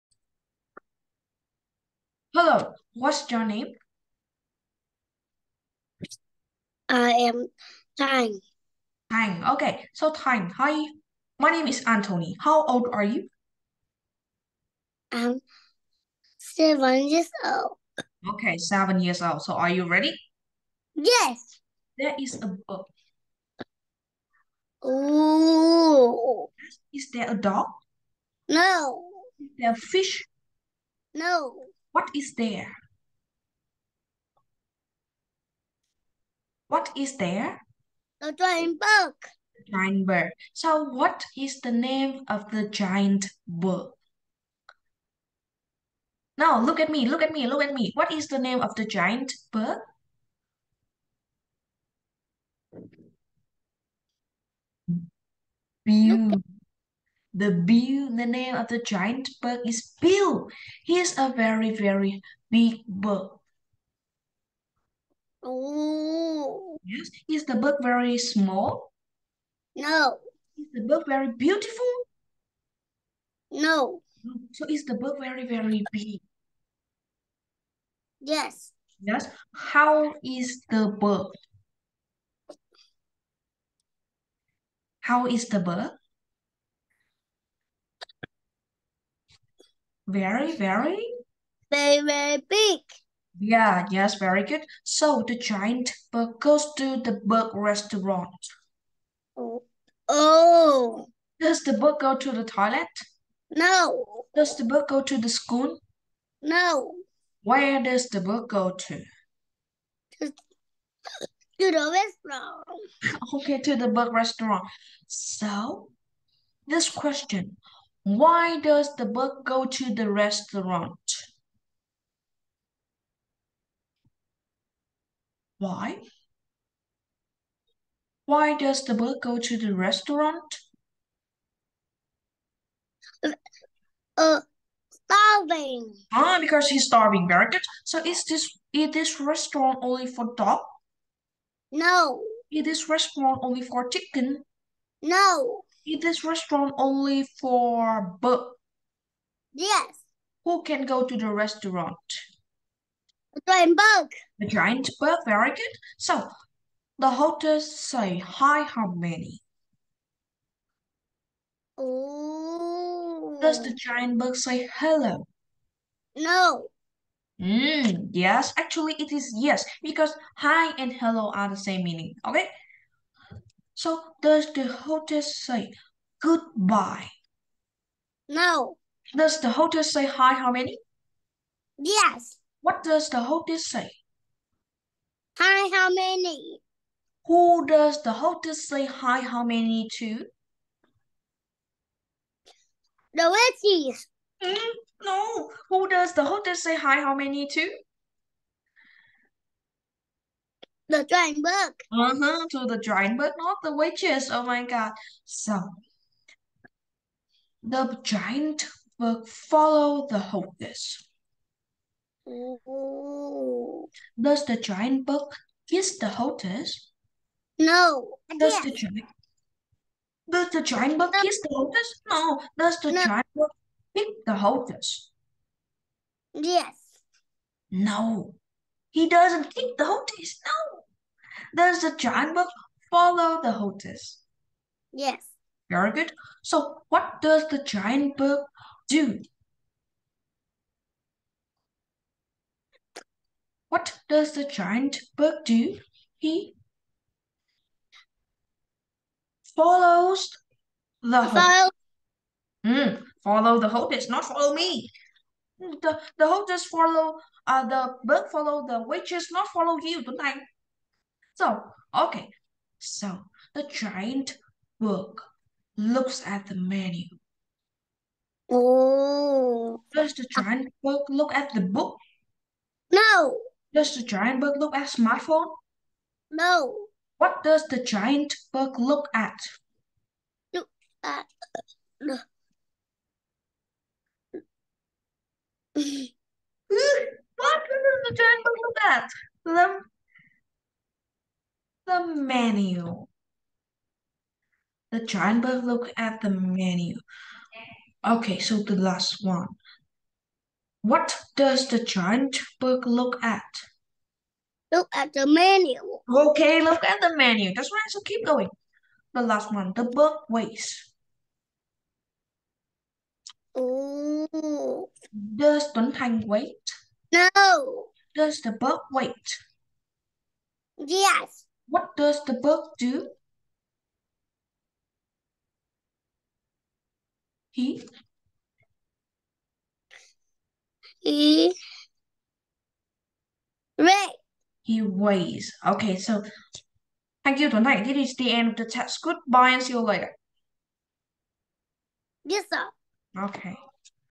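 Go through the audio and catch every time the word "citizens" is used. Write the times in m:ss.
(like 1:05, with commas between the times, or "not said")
not said.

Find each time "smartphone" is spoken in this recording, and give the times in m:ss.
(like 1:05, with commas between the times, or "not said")
4:34.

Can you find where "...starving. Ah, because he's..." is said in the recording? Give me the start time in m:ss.
2:14.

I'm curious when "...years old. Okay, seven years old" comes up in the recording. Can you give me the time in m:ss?
0:17.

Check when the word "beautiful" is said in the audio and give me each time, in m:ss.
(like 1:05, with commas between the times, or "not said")
0:55, 1:11.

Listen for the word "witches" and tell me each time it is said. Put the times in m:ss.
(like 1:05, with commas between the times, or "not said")
3:13, 3:23, 4:18.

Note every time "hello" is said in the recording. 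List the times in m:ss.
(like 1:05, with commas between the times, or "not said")
0:02, 2:44, 2:50.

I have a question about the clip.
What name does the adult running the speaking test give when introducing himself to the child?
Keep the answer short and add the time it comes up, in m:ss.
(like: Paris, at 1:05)
Anthony, at 0:11.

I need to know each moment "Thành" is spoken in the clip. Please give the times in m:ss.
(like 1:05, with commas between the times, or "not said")
5:15, 5:37.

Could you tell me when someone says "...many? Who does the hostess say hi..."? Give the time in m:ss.
3:05.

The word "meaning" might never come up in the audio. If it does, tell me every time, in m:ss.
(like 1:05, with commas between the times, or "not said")
2:51.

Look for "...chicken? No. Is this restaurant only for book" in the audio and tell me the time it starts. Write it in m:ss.
2:23.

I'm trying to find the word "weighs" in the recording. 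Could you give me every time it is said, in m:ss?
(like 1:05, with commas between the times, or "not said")
5:10, 5:34.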